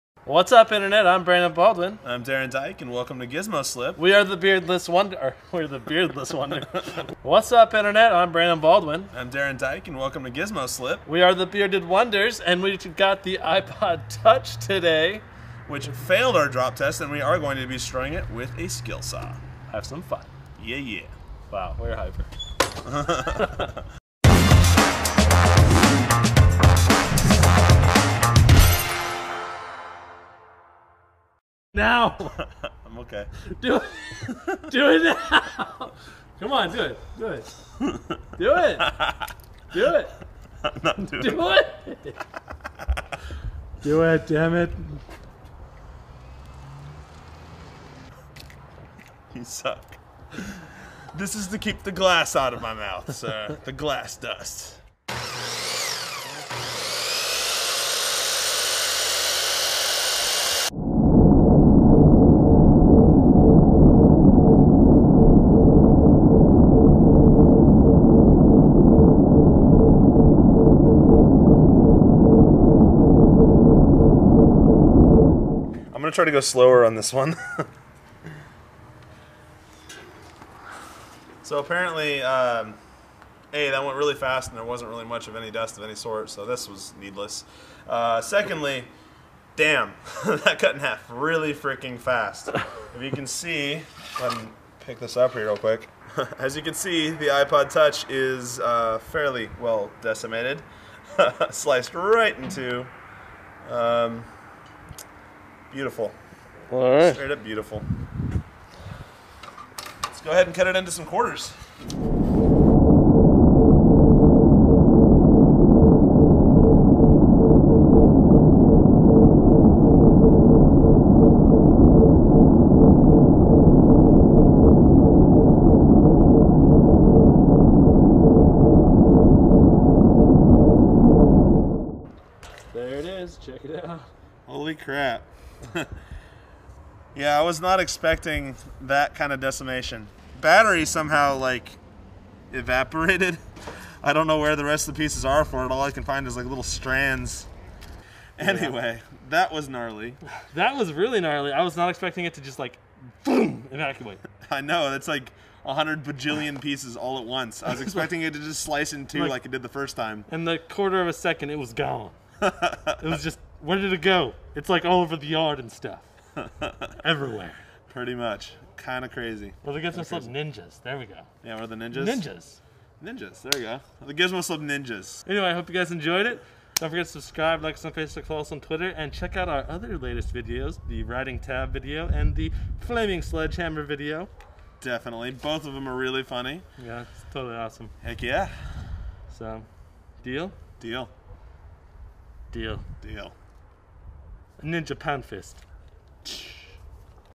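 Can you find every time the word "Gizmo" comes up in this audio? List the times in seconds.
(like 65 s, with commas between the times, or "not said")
3 s, 10 s, 169 s, 174 s.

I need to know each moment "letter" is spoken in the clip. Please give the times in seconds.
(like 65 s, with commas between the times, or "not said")
not said.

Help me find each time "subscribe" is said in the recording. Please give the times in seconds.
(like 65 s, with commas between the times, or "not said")
177 s.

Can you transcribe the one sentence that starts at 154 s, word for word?
That's like a hundred bajillion pieces all at once.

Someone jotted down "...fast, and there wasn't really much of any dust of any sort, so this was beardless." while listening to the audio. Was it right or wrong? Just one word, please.
wrong.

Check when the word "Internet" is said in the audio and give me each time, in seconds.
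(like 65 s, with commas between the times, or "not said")
0 s, 7 s.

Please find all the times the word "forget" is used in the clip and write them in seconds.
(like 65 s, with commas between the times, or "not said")
176 s.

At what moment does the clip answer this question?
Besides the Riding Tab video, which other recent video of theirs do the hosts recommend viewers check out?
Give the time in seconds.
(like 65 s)
182 s.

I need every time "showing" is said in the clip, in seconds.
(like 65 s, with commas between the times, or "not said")
not said.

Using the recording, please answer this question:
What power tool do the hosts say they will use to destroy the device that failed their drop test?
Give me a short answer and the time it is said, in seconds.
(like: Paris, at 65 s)
Skill saw, at 18 s.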